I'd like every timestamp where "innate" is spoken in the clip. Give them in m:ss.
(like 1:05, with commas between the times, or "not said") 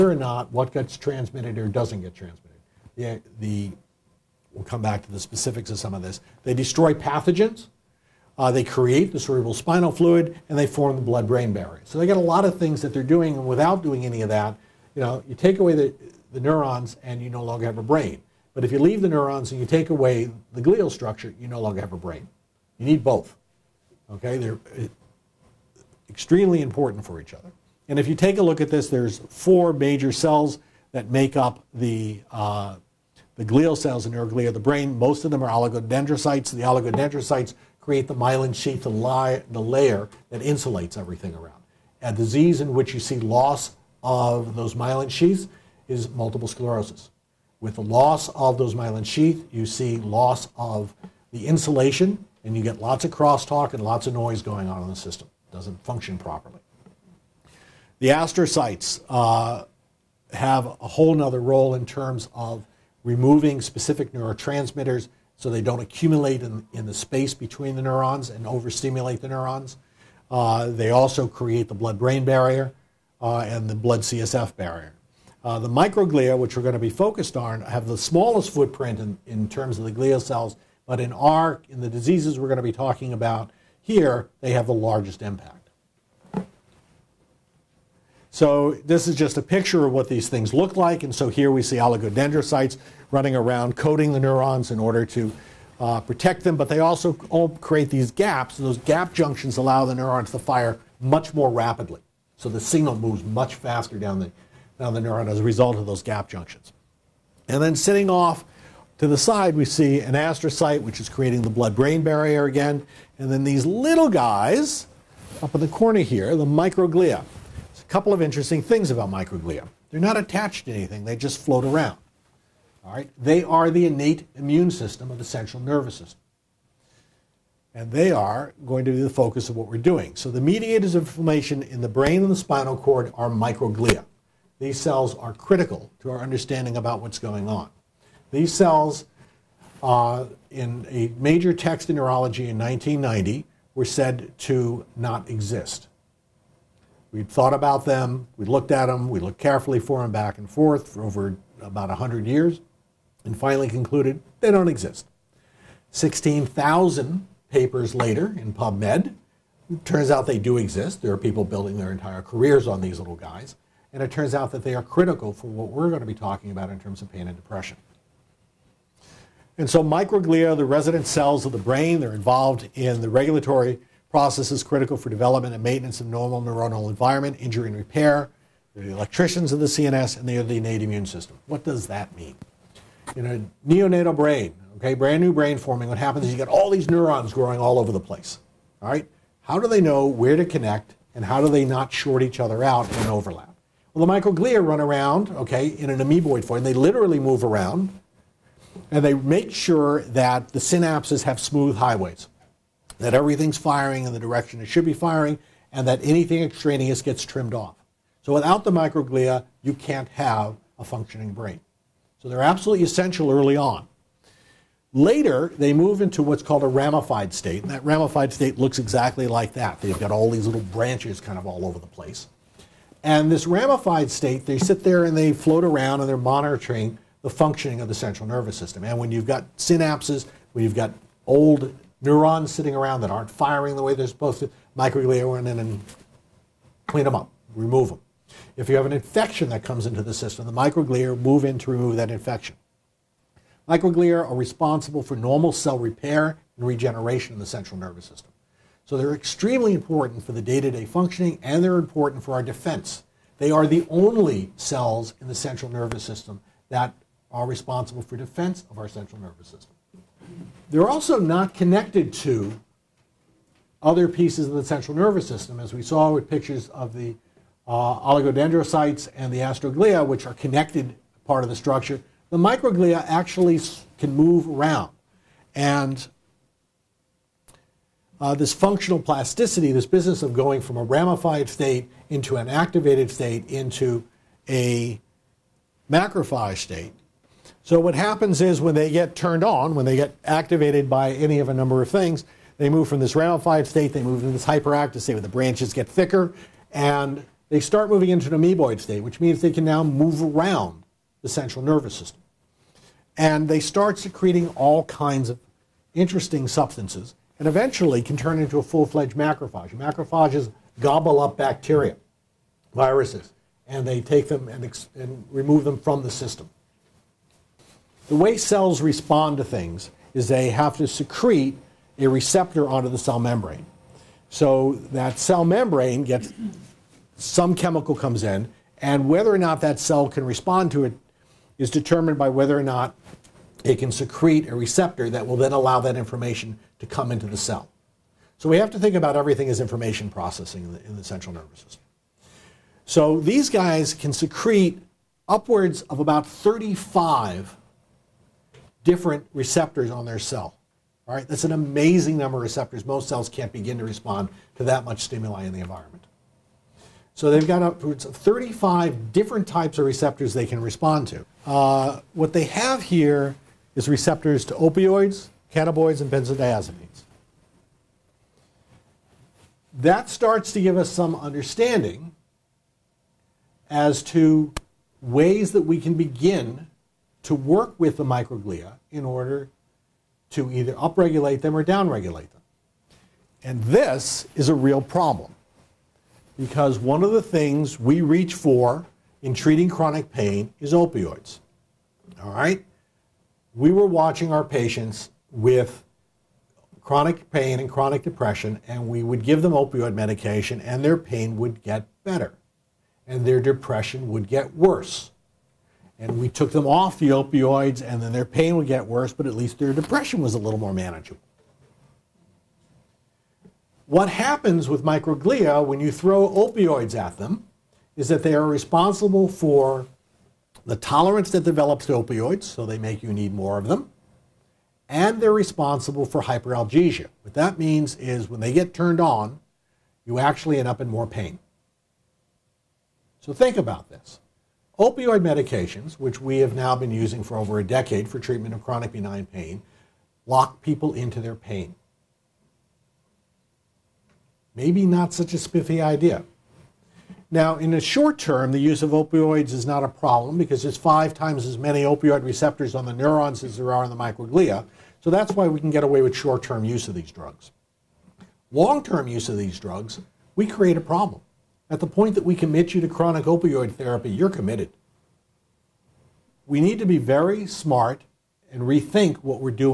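2:03, 3:00.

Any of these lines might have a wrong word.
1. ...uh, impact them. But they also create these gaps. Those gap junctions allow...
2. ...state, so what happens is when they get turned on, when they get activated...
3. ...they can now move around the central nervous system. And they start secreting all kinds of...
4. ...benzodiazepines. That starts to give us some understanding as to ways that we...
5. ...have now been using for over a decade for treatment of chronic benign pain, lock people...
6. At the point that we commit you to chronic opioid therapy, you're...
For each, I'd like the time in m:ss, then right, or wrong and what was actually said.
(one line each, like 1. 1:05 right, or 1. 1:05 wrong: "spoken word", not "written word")
1. 1:35 wrong: "protect", not "impact"
2. 4:46 right
3. 4:59 right
4. 6:06 right
5. 7:16 right
6. 7:41 right.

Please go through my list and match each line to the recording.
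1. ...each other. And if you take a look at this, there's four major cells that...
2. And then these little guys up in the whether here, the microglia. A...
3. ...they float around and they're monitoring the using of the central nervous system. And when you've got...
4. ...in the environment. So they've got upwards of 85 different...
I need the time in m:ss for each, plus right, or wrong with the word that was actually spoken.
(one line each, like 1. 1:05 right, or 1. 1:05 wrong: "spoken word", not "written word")
1. 0:27 right
2. 1:53 wrong: "corner", not "whether"
3. 3:45 wrong: "functioning", not "using"
4. 5:55 wrong: "35", not "85".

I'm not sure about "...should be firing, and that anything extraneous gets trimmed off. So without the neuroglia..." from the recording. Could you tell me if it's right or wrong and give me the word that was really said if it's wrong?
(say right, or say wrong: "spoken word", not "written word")
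wrong: "microglia", not "neuroglia".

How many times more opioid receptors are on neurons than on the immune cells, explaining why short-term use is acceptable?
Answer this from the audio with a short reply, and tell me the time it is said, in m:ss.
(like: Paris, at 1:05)
5, at 7:30.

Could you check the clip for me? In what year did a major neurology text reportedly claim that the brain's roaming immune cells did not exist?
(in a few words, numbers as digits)
1990.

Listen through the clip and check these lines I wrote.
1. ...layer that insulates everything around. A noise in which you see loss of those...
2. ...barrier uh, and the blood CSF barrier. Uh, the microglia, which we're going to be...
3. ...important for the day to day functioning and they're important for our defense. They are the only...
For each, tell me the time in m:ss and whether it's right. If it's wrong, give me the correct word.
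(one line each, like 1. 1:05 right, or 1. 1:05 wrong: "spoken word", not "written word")
1. 0:39 wrong: "disease", not "noise"
2. 1:12 right
3. 4:09 right.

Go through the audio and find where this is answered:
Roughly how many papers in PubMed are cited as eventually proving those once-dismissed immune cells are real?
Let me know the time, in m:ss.
2:35.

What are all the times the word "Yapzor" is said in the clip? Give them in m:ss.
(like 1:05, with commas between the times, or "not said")
not said.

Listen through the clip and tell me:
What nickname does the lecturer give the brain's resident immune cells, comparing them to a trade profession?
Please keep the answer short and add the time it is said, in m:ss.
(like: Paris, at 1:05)
The electricians of the CNS, at 2:58.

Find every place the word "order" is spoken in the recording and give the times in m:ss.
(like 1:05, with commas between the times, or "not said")
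1:34, 6:19.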